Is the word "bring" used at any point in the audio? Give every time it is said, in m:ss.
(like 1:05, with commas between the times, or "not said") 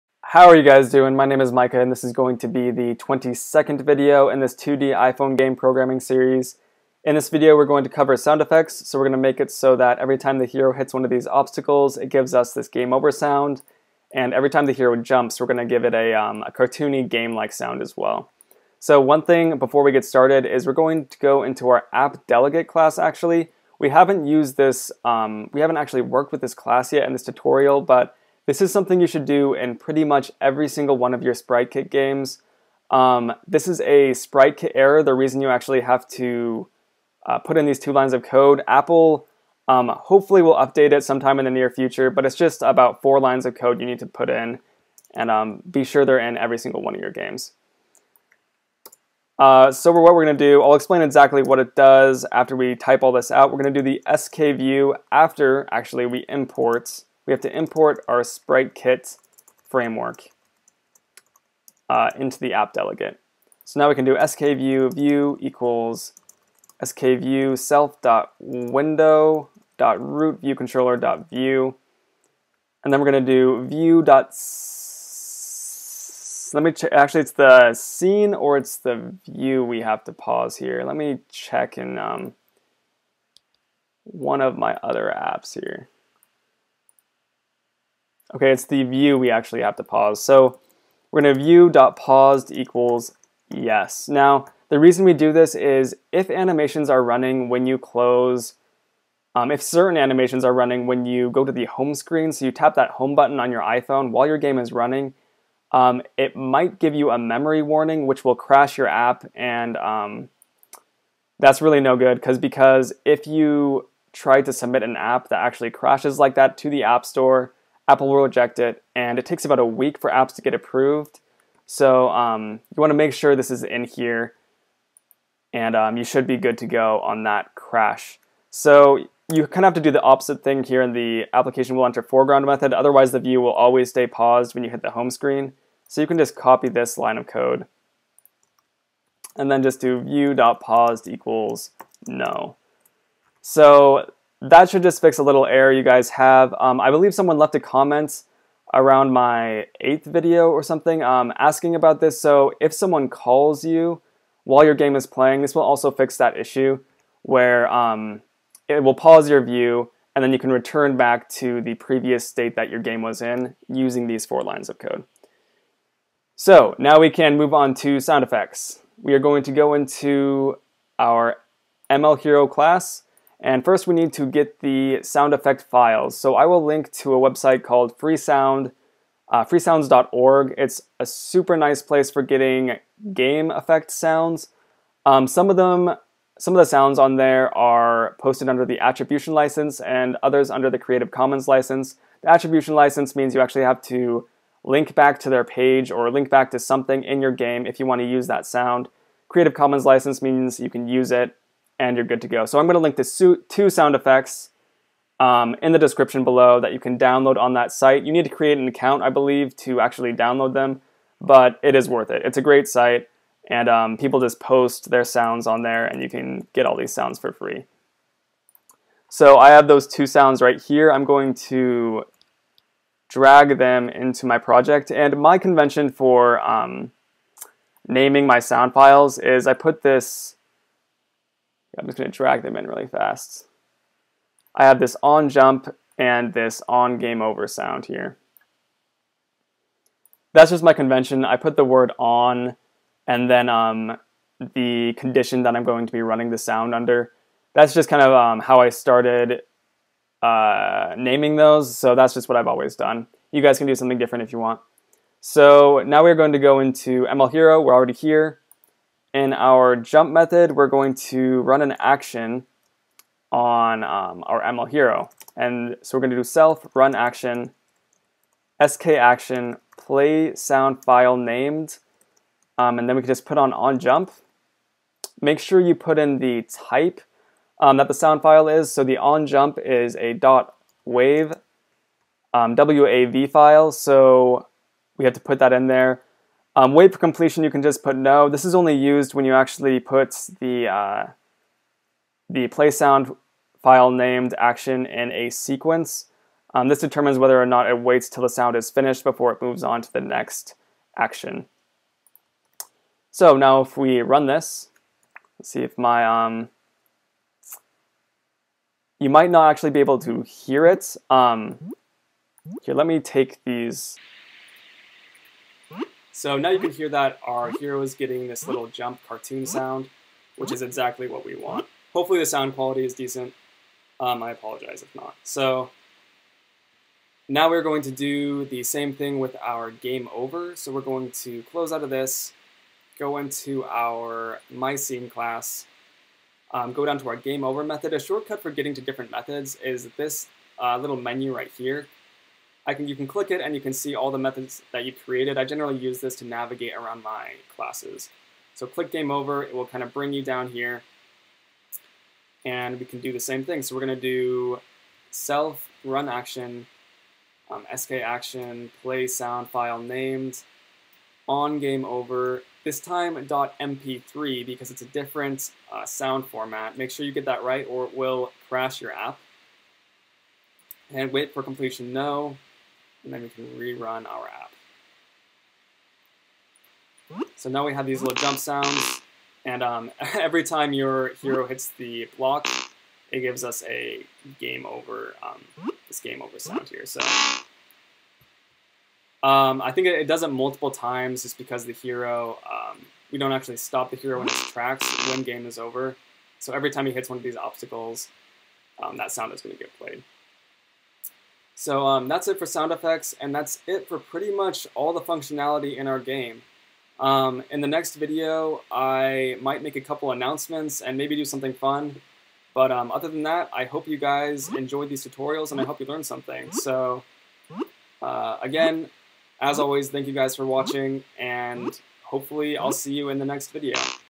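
5:49.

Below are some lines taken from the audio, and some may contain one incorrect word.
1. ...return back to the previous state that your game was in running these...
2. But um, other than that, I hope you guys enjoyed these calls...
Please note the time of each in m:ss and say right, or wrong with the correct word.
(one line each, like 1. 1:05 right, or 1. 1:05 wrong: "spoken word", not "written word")
1. 2:40 wrong: "using", not "running"
2. 6:52 wrong: "tutorials", not "calls".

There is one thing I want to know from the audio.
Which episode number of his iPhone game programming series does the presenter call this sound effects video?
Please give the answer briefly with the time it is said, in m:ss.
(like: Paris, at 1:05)
22nd, at 0:02.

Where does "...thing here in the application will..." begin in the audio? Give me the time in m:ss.
2:10.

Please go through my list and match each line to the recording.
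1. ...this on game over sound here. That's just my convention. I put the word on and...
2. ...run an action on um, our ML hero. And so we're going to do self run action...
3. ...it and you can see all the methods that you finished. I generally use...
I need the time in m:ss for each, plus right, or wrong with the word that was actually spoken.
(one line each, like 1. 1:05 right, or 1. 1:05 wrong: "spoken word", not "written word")
1. 3:56 right
2. 4:21 right
3. 5:43 wrong: "created", not "finished".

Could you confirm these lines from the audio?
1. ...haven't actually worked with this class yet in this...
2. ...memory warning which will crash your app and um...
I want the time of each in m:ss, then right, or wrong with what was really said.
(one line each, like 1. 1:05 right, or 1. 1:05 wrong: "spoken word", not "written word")
1. 0:25 right
2. 1:47 right.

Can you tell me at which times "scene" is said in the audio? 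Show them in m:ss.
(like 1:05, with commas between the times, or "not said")
1:17, 5:34.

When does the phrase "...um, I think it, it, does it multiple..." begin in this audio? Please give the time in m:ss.
6:29.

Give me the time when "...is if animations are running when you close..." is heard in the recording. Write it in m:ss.
1:35.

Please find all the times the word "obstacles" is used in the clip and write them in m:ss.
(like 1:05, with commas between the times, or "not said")
0:11, 6:37.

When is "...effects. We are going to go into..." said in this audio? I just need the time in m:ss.
2:48.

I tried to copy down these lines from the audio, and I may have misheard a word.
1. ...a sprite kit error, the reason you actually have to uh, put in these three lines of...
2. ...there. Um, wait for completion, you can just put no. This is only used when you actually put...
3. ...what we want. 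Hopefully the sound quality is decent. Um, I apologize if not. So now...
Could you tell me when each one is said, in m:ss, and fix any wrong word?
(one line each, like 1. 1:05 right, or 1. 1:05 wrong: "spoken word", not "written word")
1. 0:33 wrong: "two", not "three"
2. 4:45 right
3. 5:21 right.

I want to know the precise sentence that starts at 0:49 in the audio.
Uh, so what we're going to do, I'll explain exactly what it does after we type all this out.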